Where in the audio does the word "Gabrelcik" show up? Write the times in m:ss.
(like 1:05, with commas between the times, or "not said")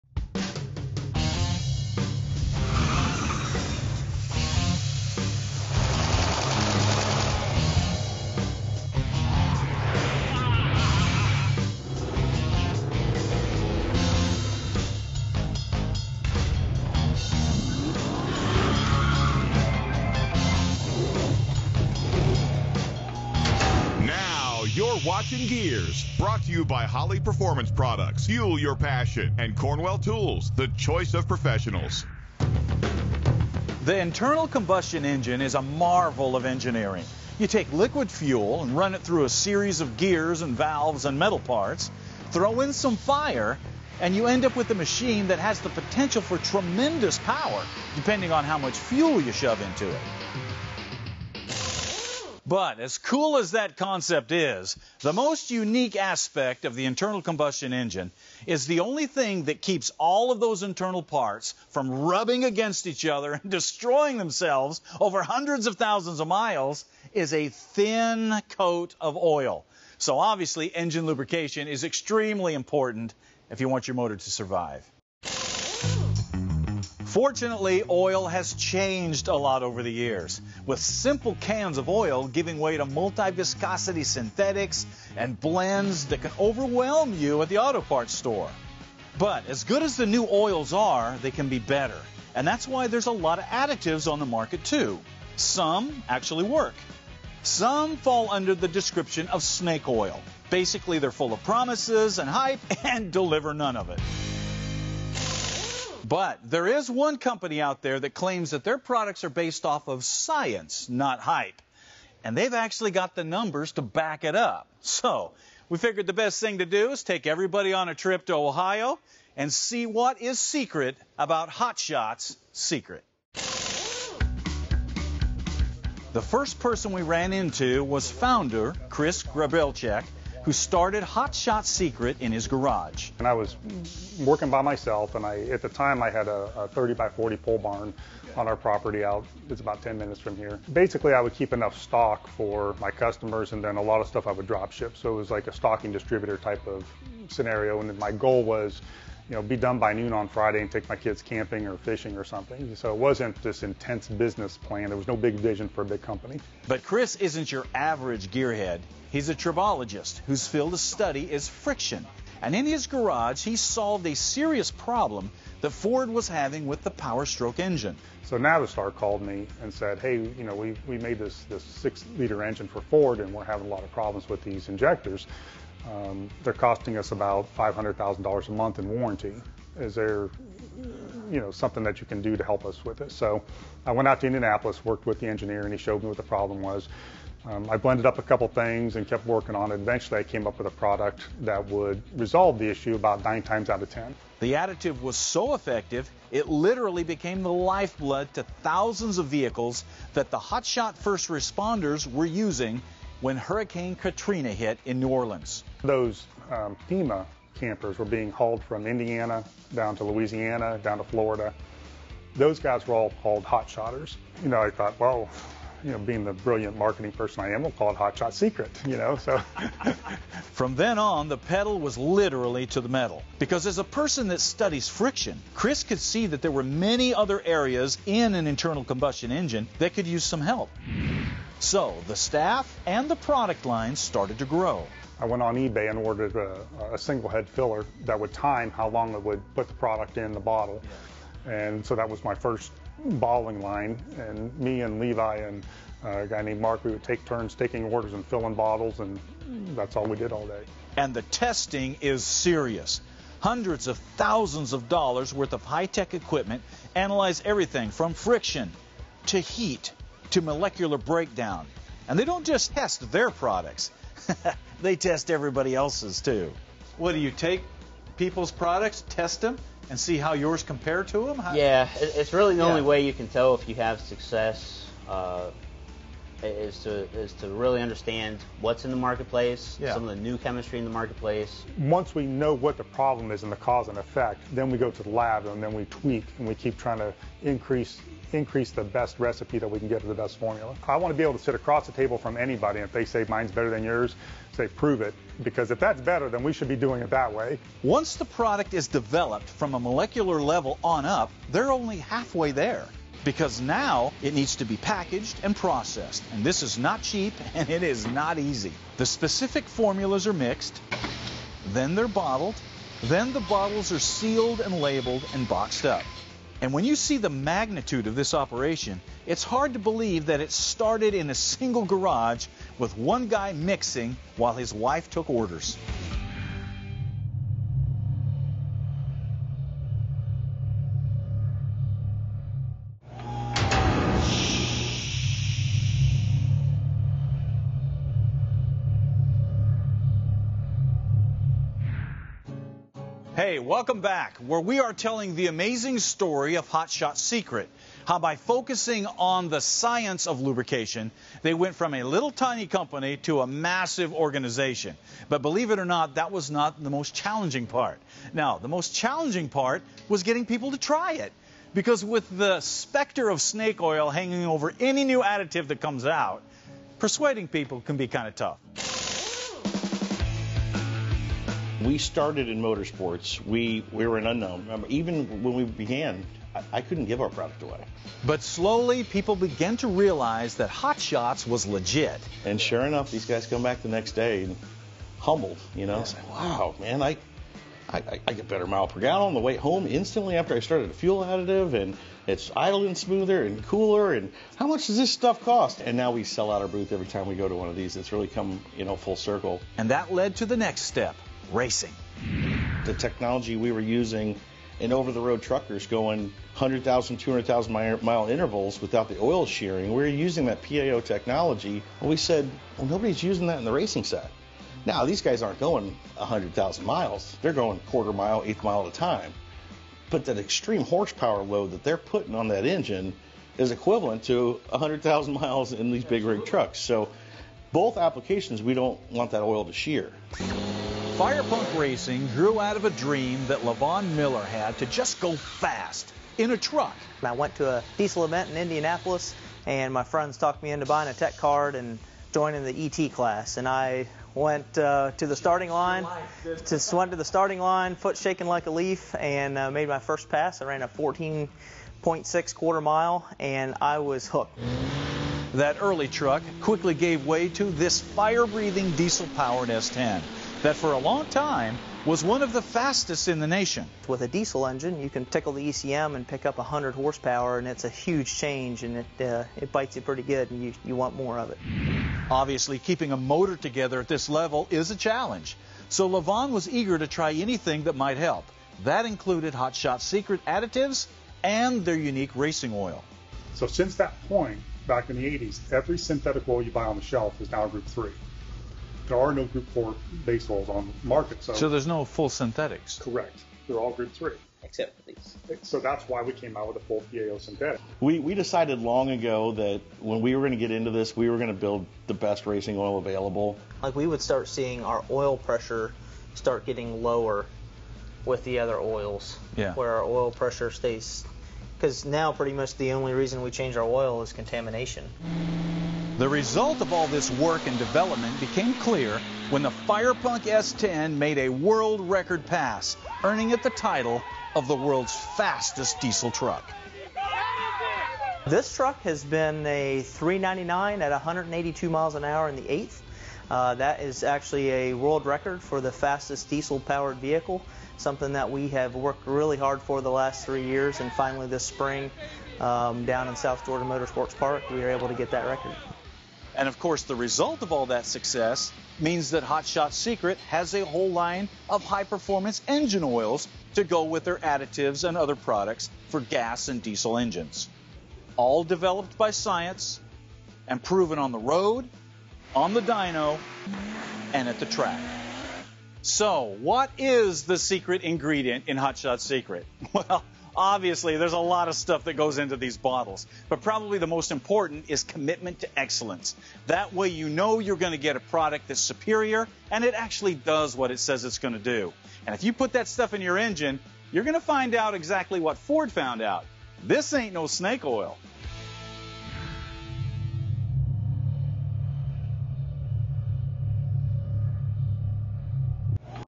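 2:09.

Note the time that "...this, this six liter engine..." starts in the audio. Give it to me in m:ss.
2:51.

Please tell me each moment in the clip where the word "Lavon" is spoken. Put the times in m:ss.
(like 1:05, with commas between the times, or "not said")
7:13, 7:56.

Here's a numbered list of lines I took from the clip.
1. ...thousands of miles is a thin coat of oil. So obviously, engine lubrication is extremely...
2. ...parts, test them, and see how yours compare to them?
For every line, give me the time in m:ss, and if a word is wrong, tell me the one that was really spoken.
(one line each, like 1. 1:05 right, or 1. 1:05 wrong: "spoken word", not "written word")
1. 1:05 right
2. 4:28 wrong: "products", not "parts".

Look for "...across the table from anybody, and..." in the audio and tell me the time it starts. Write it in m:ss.
4:51.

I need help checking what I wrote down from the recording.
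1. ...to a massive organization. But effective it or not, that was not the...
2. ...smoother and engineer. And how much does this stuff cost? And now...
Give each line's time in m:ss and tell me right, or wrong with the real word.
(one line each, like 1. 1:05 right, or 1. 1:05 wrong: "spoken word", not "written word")
1. 5:53 wrong: "believe", not "effective"
2. 6:32 wrong: "cooler", not "engineer".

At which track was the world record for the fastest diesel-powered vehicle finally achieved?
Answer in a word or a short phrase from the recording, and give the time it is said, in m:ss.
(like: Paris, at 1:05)
South Georgia Motorsports Park, at 9:03.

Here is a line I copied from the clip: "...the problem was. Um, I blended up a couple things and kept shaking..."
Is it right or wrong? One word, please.
wrong.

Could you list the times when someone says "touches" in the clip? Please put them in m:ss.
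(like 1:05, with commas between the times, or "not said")
not said.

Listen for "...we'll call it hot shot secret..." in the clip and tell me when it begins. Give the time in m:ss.
3:37.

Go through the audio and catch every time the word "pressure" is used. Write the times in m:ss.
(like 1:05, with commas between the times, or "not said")
8:25, 8:30.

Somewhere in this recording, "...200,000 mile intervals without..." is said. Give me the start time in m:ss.
6:47.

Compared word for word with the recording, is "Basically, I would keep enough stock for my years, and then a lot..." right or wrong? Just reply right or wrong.
wrong.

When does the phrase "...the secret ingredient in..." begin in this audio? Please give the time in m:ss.
9:27.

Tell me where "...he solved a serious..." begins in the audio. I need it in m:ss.
2:43.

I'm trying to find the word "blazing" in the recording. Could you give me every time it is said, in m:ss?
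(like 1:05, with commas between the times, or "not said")
not said.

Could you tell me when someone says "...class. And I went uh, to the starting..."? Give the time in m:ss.
7:23.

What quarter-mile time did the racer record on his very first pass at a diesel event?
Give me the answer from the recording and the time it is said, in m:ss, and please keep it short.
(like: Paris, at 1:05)
14.6, at 7:30.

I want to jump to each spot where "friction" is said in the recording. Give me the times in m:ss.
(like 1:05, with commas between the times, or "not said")
2:41, 3:44, 4:18.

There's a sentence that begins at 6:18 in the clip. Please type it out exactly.
But slowly, people began to realize that Hot Shots was legit.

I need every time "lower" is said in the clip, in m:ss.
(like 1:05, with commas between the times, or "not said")
8:27.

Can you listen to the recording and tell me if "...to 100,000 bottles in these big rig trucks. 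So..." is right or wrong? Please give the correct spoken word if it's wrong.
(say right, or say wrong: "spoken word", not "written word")
wrong: "miles", not "bottles".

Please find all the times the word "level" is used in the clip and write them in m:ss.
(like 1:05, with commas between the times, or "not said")
5:00, 7:54.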